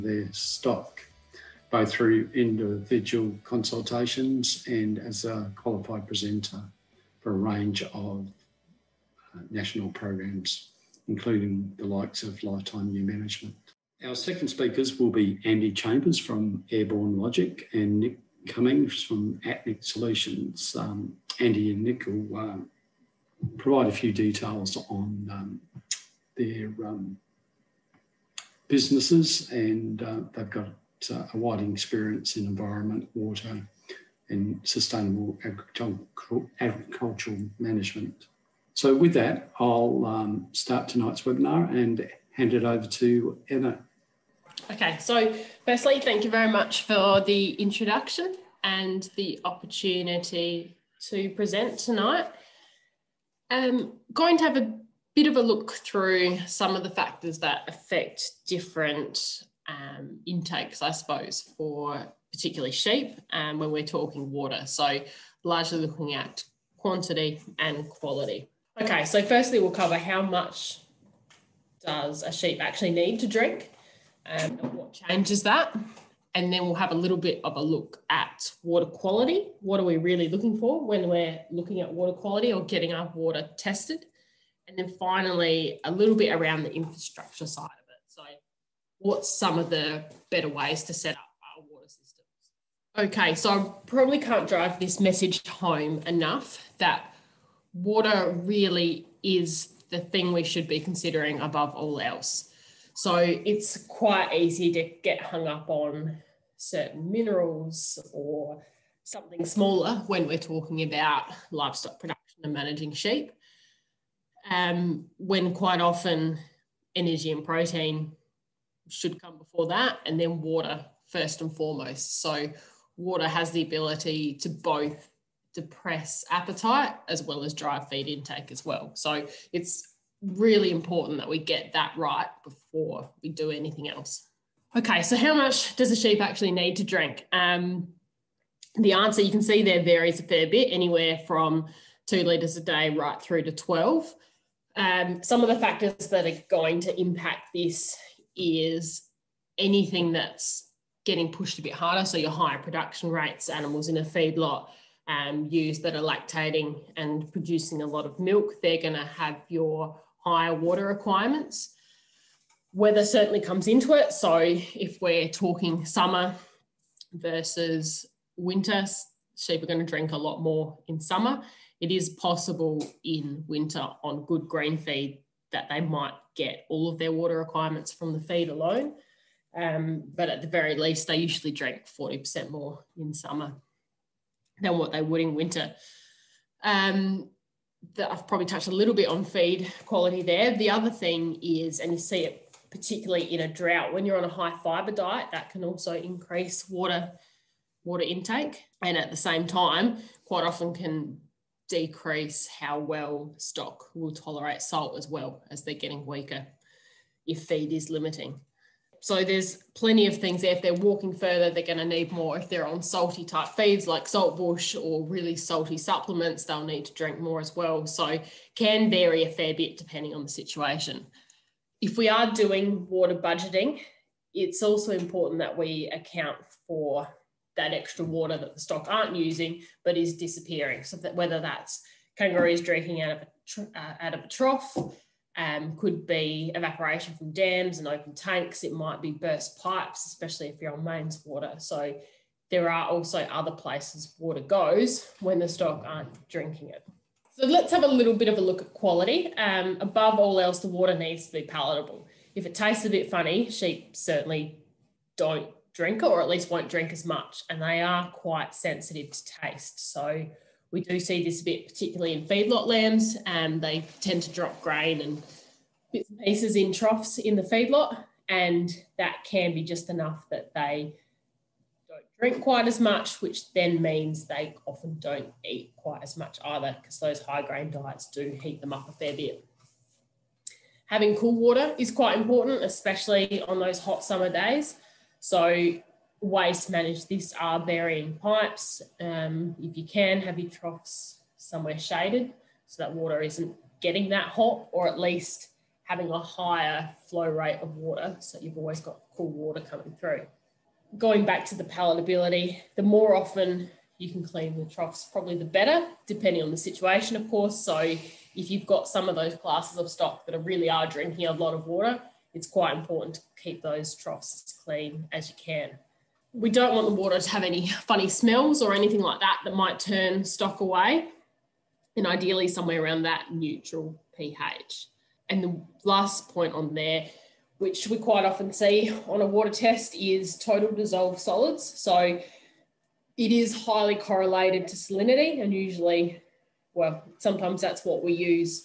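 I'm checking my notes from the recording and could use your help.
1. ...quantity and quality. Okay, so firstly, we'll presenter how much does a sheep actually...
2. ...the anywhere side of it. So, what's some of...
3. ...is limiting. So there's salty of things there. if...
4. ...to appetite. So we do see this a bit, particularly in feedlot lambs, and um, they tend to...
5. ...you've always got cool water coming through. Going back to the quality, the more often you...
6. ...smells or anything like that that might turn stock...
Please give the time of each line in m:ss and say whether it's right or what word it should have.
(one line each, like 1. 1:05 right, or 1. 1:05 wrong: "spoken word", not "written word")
1. 1:06 wrong: "cover", not "presenter"
2. 1:26 wrong: "infrastructure", not "anywhere"
3. 3:27 wrong: "plenty", not "salty"
4. 4:19 wrong: "taste", not "appetite"
5. 4:58 wrong: "palatability", not "quality"
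6. 5:18 right.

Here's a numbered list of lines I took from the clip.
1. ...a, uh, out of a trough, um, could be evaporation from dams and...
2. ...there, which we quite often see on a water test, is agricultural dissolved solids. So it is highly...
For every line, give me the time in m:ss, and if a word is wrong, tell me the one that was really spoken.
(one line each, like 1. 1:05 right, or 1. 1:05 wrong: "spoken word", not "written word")
1. 3:53 right
2. 5:26 wrong: "total", not "agricultural".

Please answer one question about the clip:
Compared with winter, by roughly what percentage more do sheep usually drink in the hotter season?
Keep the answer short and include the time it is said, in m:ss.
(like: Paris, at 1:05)
40%, at 3:01.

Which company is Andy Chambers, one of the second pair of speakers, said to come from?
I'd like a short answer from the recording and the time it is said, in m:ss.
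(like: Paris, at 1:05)
Airborne Logic, at 0:16.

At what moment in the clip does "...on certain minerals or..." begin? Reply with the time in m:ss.
1:45.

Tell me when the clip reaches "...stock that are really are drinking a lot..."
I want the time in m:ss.
5:09.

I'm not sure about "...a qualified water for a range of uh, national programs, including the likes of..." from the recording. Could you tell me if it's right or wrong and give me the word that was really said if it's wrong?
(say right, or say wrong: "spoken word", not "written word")
wrong: "presenter", not "water".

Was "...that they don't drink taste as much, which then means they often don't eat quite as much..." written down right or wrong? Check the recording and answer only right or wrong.
wrong.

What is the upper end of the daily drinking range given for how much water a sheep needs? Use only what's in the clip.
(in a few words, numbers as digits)
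12 litres.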